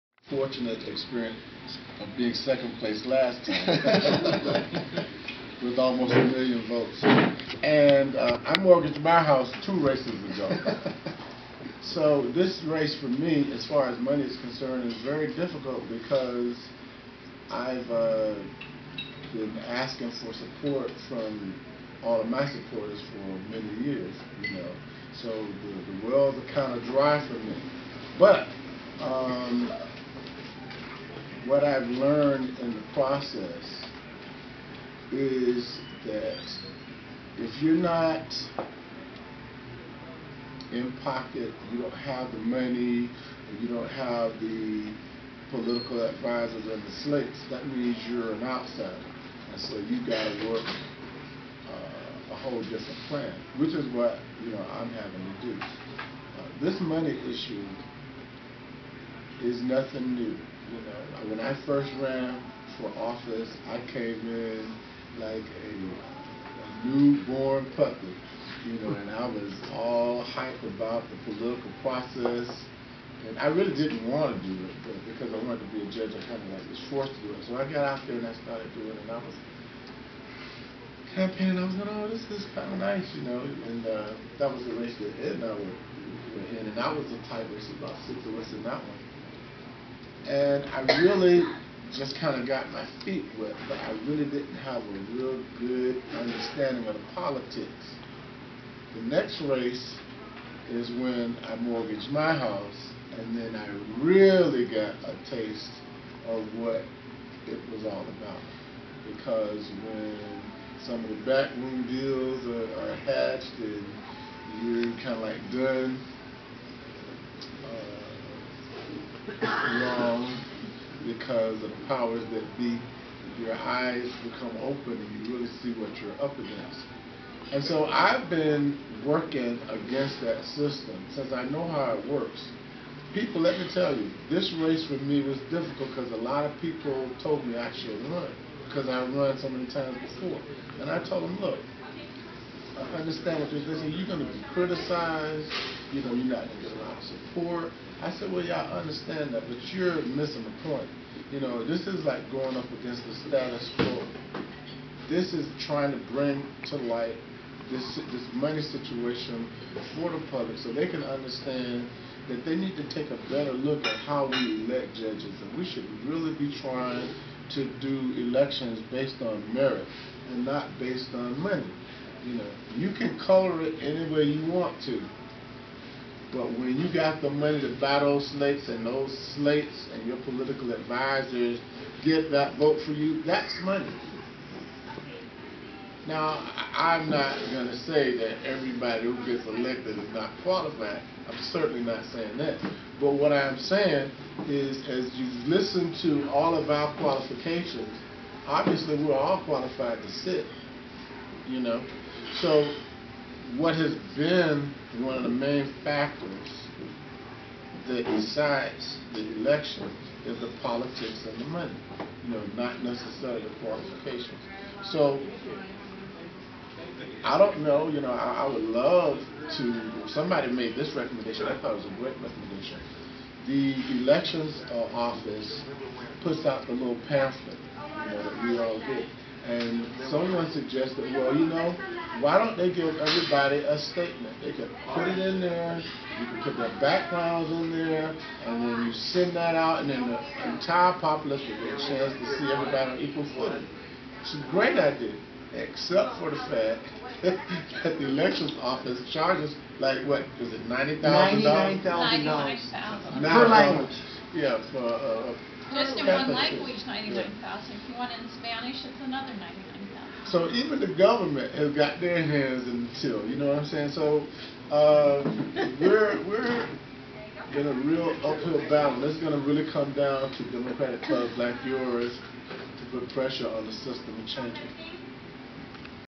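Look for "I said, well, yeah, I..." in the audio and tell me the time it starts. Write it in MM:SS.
02:28.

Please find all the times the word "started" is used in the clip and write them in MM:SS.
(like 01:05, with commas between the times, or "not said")
01:18.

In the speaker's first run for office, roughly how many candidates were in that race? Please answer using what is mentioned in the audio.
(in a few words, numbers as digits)
about 6.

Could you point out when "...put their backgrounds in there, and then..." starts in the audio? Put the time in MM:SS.
03:56.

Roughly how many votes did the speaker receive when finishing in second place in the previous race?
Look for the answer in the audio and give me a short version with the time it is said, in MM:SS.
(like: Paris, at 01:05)
almost a million, at 00:05.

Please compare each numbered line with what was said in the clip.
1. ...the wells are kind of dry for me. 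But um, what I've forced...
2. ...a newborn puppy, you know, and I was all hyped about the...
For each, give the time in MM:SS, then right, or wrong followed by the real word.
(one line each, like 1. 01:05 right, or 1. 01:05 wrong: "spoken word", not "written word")
1. 00:26 wrong: "learned", not "forced"
2. 01:06 right.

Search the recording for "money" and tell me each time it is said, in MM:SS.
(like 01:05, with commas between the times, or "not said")
00:13, 00:42, 00:56, 02:38, 02:51, 02:57, 03:03, 03:31.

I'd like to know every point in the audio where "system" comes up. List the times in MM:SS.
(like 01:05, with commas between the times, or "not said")
02:10, 04:33.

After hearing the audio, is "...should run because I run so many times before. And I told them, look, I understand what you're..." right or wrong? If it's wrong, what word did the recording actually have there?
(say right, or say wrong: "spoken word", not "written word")
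right.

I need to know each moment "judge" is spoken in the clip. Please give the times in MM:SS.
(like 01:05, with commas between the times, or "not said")
01:15, 02:44.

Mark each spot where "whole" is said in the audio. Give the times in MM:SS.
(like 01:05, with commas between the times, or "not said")
00:52.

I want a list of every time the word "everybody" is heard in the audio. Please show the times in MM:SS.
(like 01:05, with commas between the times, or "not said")
03:08, 03:52, 04:02.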